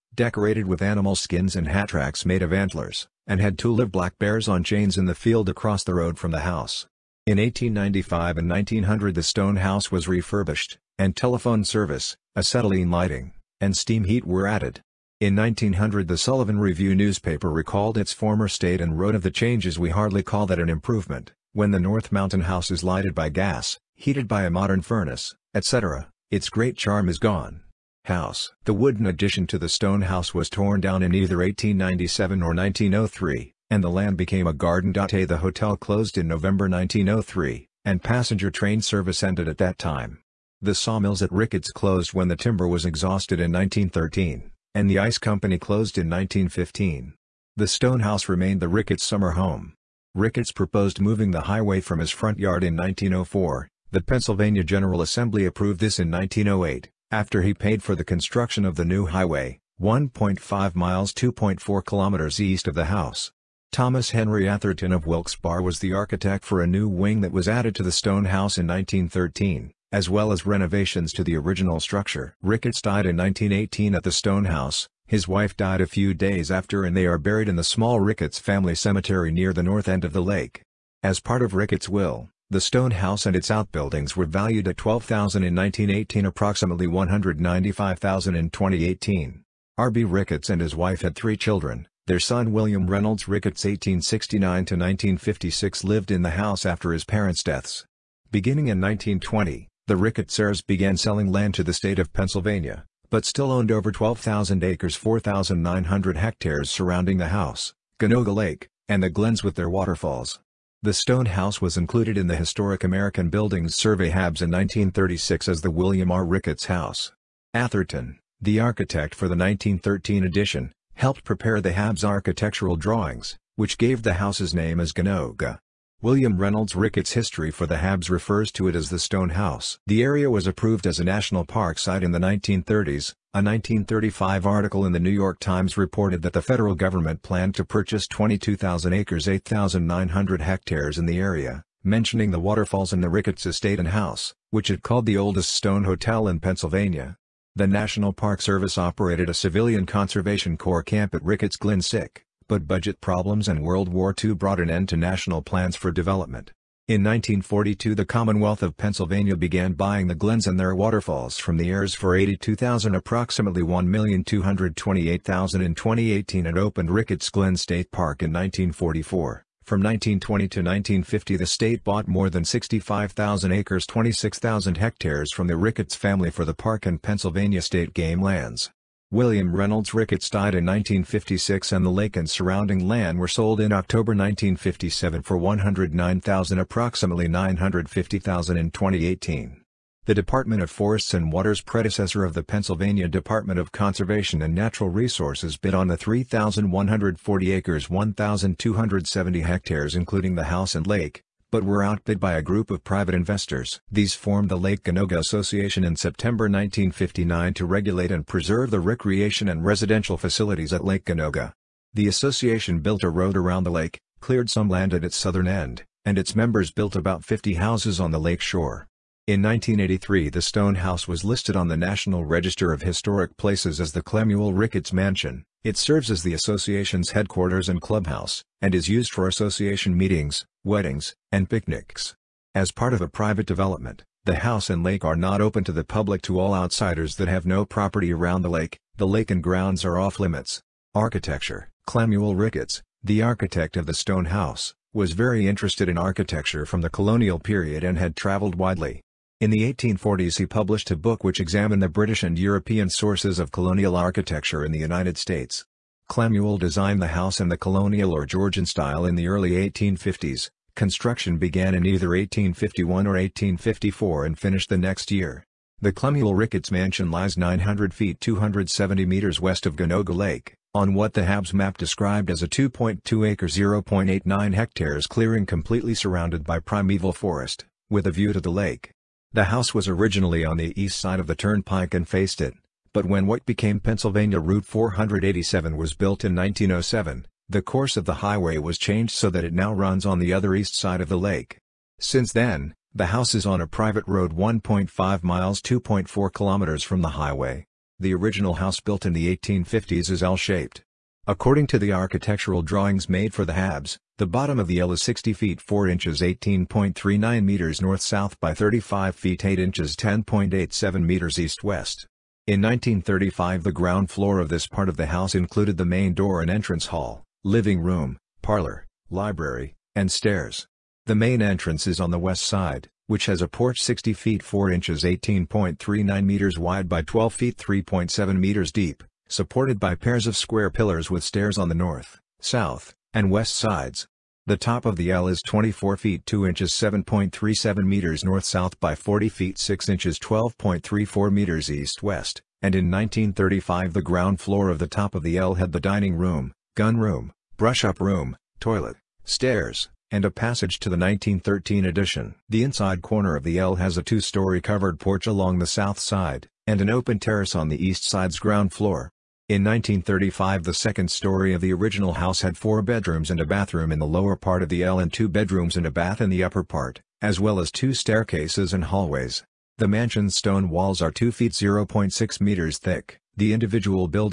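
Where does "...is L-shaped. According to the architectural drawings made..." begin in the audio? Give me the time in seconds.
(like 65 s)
300 s.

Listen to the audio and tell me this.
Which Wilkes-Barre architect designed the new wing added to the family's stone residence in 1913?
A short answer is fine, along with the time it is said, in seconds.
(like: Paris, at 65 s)
Thomas Henry Atherton, at 63 s.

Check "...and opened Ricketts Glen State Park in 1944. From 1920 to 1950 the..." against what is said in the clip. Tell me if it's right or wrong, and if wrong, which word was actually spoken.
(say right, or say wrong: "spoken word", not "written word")
right.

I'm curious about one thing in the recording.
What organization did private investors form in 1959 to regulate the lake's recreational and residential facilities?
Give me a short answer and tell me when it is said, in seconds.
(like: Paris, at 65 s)
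Lake Ganoga Association, at 204 s.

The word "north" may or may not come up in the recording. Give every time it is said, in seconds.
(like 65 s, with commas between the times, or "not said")
21 s, 79 s, 307 s, 331 s, 338 s.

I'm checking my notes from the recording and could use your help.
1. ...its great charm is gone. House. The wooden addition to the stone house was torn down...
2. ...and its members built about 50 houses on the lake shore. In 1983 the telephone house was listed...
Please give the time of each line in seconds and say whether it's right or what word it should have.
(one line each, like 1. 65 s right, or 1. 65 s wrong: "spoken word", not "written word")
1. 26 s right
2. 216 s wrong: "stone", not "telephone".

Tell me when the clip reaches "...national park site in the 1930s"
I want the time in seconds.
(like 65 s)
131 s.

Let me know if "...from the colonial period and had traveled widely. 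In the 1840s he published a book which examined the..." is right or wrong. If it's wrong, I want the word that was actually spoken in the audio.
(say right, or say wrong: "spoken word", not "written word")
right.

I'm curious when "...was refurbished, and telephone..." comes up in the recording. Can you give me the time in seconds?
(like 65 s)
9 s.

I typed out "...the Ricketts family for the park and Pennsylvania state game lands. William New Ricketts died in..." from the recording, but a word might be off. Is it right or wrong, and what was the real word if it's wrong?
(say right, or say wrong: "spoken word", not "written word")
wrong: "Reynolds", not "New".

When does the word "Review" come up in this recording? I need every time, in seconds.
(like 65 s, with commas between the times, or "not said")
16 s.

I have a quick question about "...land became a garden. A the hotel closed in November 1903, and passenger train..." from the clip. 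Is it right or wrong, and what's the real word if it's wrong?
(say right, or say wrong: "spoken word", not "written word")
right.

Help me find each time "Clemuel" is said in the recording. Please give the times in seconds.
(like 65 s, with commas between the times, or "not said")
224 s, 241 s, 256 s, 265 s.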